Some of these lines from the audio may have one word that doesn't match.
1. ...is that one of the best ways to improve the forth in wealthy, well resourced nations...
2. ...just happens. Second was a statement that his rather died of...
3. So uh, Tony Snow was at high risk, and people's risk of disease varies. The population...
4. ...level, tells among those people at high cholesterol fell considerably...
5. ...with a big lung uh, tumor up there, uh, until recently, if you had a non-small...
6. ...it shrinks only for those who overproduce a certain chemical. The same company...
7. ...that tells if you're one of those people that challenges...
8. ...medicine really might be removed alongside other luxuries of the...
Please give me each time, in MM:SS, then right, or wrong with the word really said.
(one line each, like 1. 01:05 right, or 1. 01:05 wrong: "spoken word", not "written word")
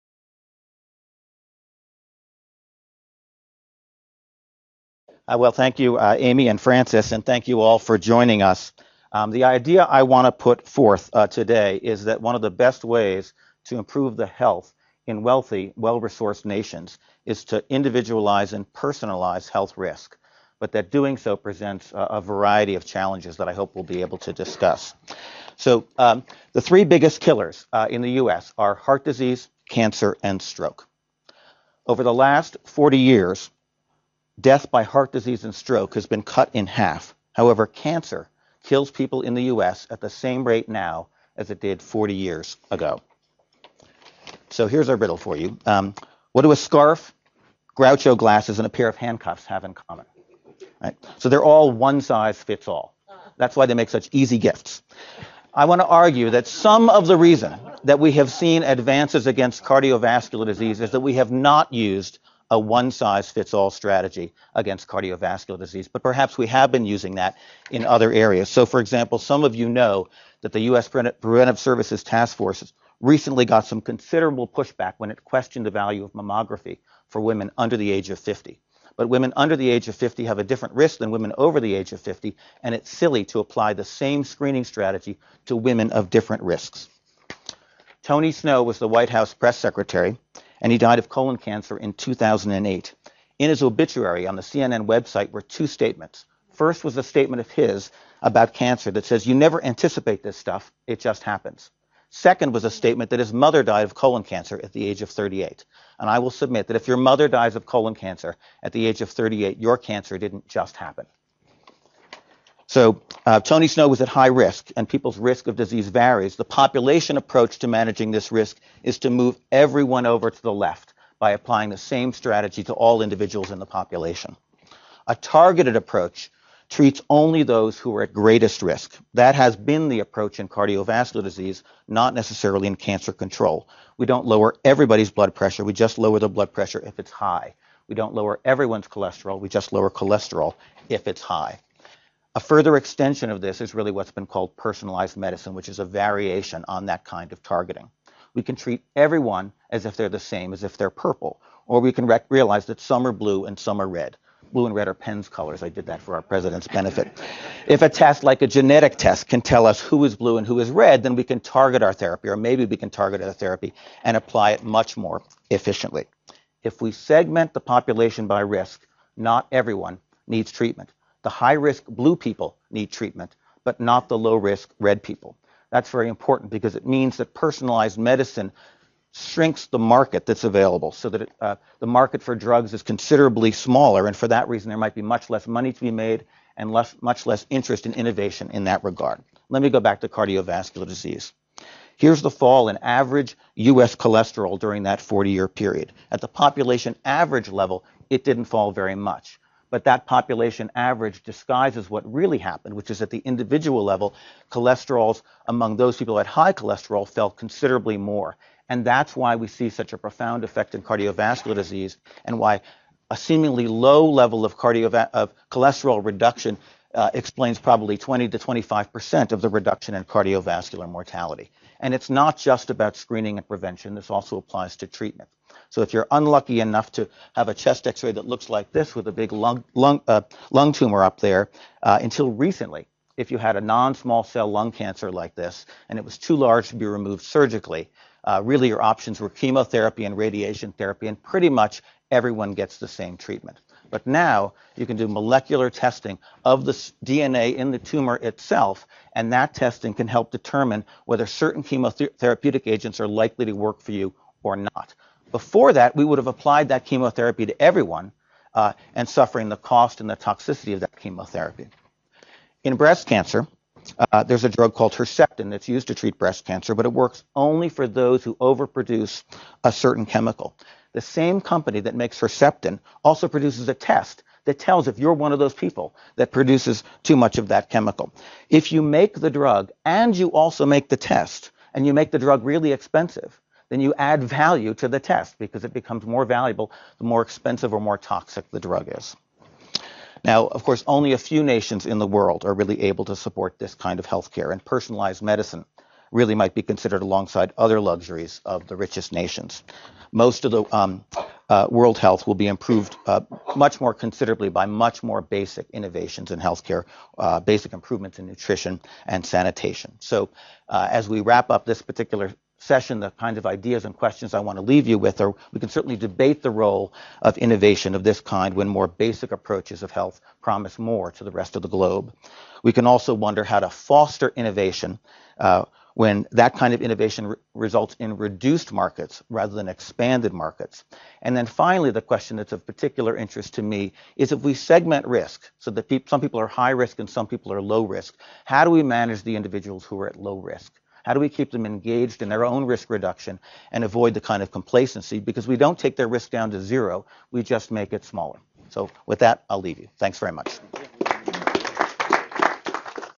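1. 00:11 wrong: "health", not "forth"
2. 01:40 wrong: "mother", not "rather"
3. 01:52 right
4. 03:23 wrong: "cholesterols", not "tells"
5. 03:48 right
6. 04:26 wrong: "works", not "shrinks"
7. 04:34 wrong: "produces", not "challenges"
8. 04:55 wrong: "considered", not "removed".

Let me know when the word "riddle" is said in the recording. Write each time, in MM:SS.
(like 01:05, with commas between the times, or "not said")
00:44.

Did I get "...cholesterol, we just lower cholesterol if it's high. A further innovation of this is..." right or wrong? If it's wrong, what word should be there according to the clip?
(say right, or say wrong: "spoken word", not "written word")
wrong: "extension", not "innovation".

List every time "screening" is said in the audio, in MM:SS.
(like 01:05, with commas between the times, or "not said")
01:24, 03:42.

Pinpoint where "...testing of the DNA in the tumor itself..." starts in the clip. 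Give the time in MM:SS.
04:05.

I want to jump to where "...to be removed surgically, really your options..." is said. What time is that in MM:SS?
03:56.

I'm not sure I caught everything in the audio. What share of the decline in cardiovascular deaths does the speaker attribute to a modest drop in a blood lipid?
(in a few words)
20 to 25 percent.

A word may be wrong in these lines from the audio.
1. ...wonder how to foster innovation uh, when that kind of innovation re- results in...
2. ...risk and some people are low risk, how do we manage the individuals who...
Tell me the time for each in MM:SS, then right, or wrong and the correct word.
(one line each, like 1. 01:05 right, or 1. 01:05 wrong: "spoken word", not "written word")
1. 05:23 right
2. 05:36 right.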